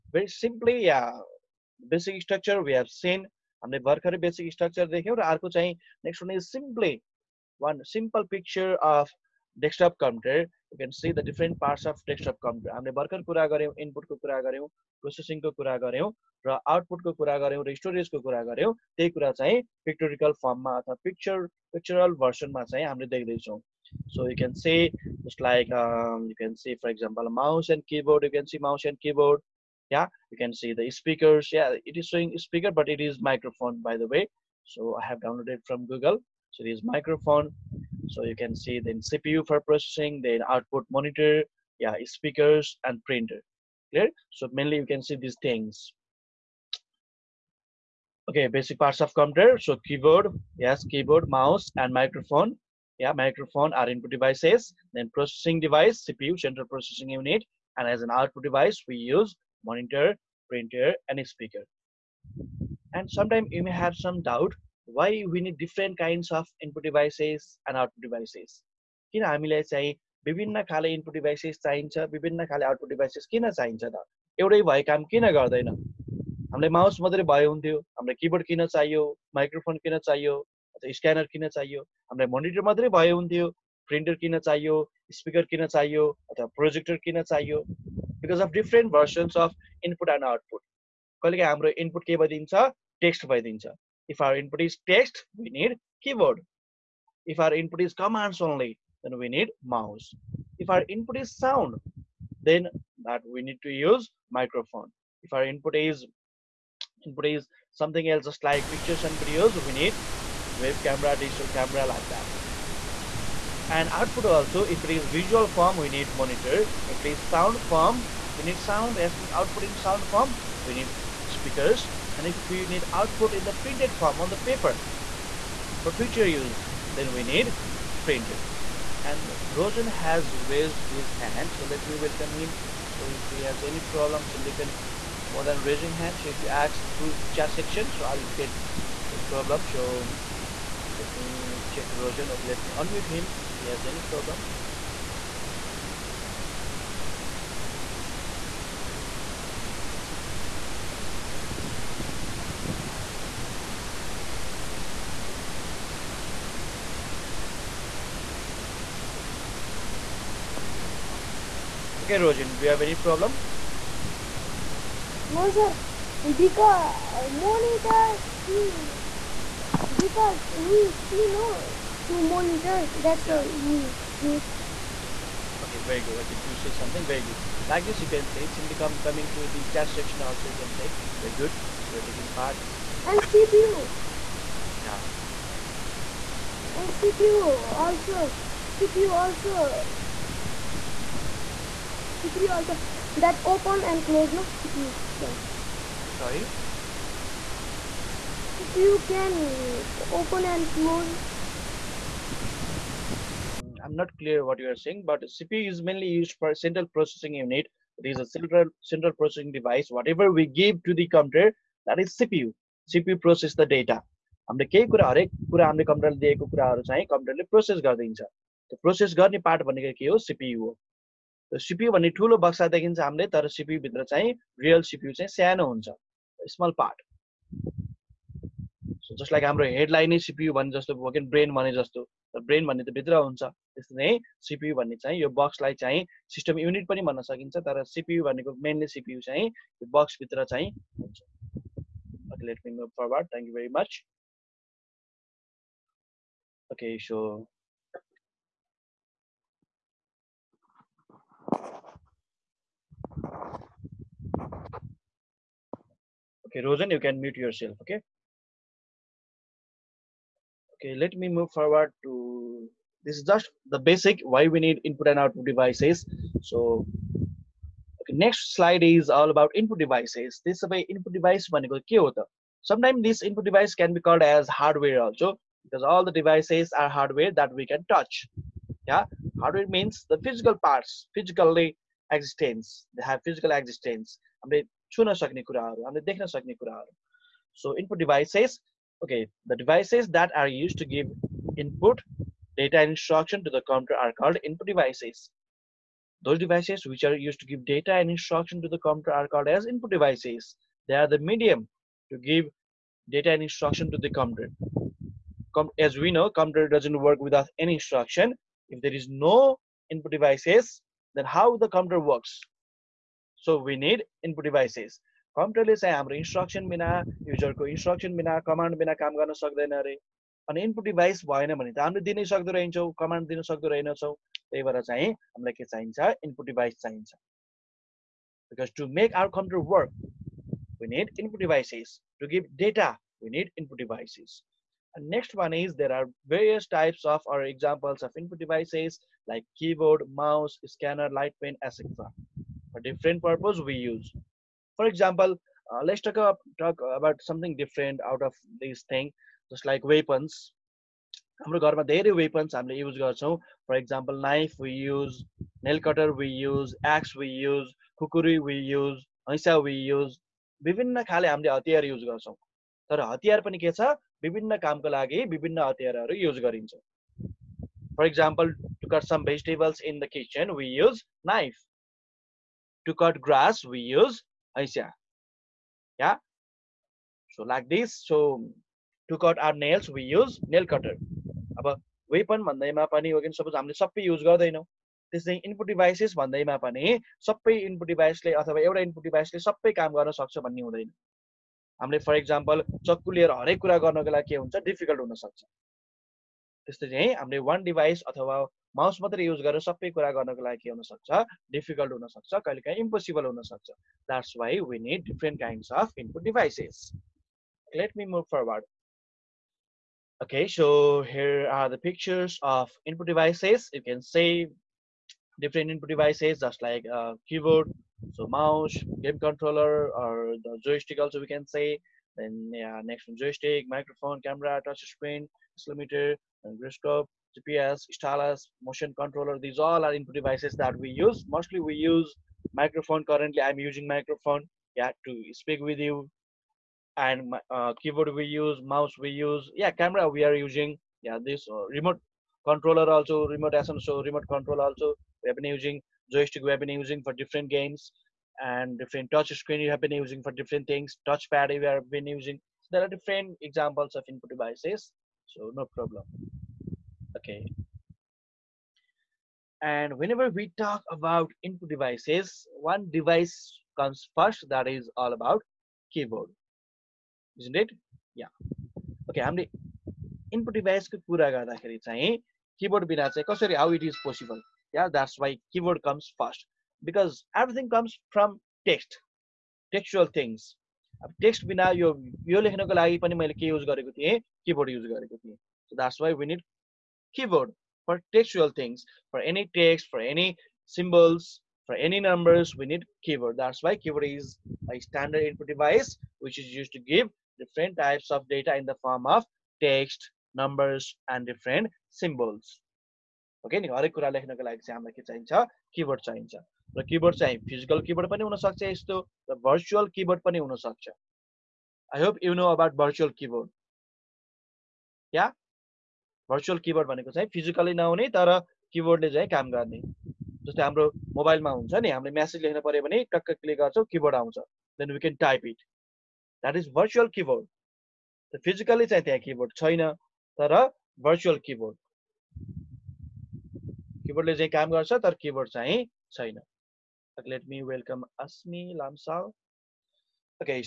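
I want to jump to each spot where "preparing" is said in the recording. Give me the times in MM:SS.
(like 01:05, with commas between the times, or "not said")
not said.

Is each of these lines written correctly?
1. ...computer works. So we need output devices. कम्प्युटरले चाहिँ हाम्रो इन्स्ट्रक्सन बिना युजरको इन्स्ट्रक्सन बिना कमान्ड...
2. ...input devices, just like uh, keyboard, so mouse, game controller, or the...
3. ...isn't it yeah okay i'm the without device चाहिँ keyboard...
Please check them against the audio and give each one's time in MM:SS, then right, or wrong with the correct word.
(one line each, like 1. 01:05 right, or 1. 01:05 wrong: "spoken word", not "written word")
1. 05:11 wrong: "input", not "output"
2. 06:55 right
3. 07:47 wrong: "input", not "without".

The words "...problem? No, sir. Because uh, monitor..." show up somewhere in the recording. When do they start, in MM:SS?
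02:42.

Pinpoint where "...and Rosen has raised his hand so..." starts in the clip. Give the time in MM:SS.
02:09.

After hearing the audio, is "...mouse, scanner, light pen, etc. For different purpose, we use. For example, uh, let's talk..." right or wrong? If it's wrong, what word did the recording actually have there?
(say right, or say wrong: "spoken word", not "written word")
right.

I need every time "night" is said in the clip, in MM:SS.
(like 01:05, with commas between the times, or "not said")
not said.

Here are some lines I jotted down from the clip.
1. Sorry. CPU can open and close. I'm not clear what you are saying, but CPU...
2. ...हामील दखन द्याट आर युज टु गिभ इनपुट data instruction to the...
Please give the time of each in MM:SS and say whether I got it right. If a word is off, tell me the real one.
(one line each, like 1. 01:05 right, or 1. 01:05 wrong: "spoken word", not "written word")
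1. 03:16 right
2. 04:45 right.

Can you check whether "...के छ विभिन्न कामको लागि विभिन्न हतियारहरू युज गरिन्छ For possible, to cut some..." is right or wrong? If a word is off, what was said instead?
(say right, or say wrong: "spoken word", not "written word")
wrong: "example", not "possible".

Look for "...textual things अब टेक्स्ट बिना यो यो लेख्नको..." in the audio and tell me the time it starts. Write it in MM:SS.
07:59.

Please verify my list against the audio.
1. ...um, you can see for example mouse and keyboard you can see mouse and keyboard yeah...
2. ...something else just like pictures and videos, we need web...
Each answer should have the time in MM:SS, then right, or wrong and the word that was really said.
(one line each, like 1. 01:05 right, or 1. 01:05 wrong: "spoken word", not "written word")
1. 00:25 right
2. 01:47 right.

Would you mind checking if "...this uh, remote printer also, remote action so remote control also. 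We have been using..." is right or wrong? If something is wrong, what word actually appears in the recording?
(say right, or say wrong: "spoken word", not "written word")
wrong: "controller", not "printer".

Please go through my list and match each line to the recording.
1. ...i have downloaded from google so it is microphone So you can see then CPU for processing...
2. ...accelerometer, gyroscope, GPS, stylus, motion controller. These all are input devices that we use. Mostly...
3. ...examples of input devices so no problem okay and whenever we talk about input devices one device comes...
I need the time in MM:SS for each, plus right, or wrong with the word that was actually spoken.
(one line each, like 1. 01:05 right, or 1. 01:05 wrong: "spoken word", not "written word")
1. 00:35 right
2. 07:05 right
3. 07:33 right.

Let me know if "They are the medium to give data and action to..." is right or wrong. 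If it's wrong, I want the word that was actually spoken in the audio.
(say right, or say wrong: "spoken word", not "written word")
wrong: "instruction", not "action".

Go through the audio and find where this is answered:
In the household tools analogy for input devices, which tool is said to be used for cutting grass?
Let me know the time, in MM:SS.
06:12.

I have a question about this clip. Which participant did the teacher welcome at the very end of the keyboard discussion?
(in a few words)
Asmi Lamsal.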